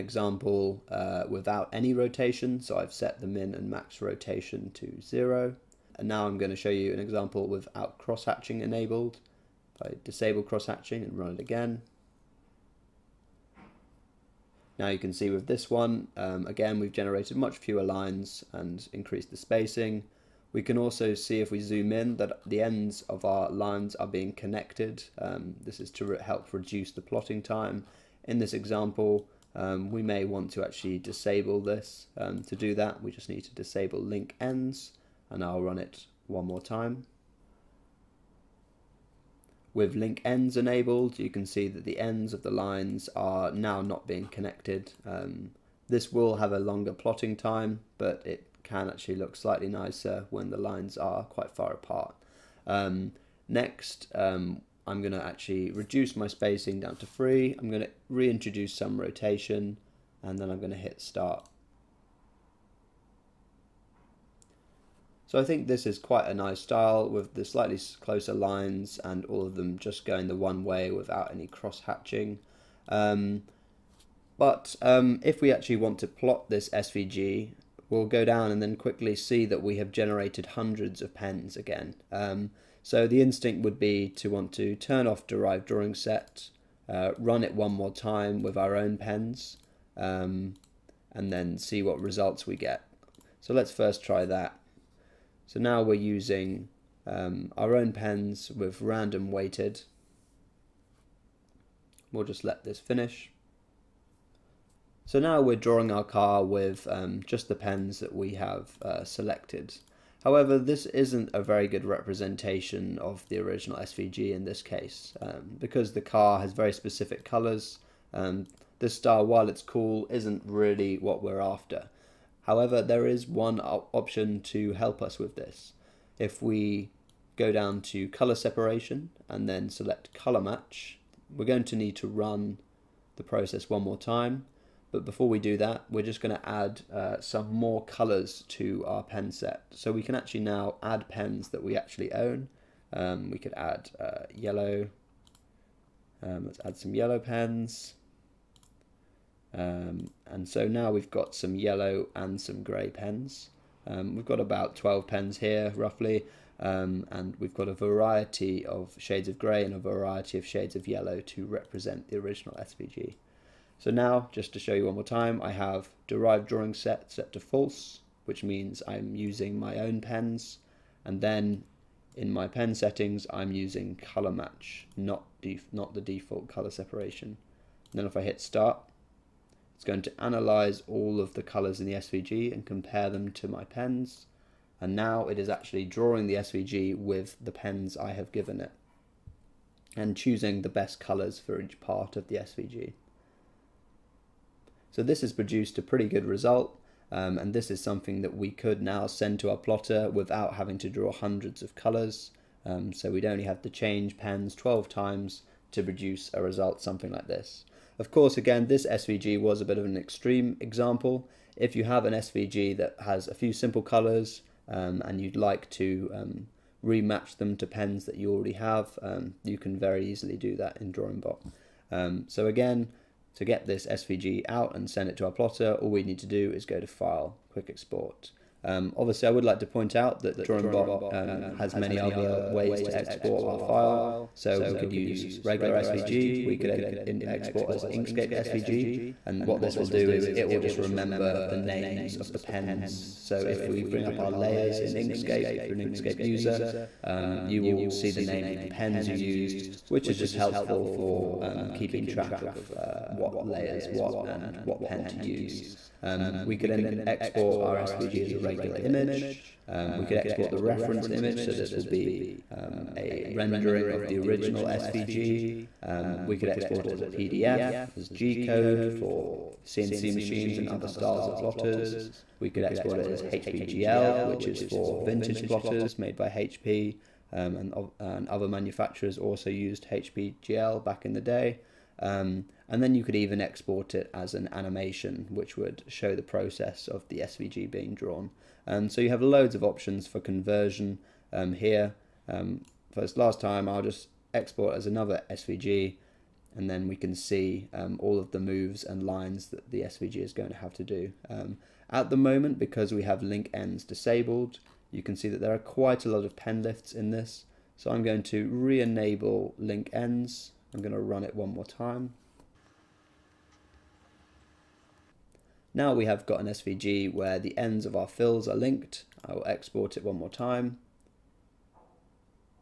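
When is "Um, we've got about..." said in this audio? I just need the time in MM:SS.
02:33.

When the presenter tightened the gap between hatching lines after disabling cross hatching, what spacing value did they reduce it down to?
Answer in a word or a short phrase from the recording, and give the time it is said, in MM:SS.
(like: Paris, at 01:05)
3, at 00:57.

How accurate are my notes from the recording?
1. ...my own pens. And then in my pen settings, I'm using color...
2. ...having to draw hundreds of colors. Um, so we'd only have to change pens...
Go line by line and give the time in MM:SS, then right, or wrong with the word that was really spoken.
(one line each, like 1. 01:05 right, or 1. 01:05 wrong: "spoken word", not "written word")
1. 02:49 right
2. 03:20 right.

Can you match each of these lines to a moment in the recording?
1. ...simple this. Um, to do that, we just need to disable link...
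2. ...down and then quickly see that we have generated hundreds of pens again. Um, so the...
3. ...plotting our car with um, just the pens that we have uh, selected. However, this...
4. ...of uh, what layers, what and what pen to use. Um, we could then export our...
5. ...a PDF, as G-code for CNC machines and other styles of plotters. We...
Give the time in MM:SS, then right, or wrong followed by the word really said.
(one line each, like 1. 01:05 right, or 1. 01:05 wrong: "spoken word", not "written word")
1. 00:30 wrong: "disable", not "simple"
2. 01:18 right
3. 01:45 wrong: "drawing", not "plotting"
4. 04:12 right
5. 04:27 right.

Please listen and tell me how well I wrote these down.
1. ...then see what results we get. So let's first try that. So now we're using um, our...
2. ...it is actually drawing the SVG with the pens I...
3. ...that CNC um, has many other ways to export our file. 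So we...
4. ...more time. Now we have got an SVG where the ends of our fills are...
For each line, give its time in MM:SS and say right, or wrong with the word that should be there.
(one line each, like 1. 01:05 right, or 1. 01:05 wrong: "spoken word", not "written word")
1. 01:31 right
2. 03:05 right
3. 03:50 wrong: "DrawingBot", not "CNC"
4. 05:11 right.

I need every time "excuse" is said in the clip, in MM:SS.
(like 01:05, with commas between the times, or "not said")
not said.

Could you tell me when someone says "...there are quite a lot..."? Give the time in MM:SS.
05:05.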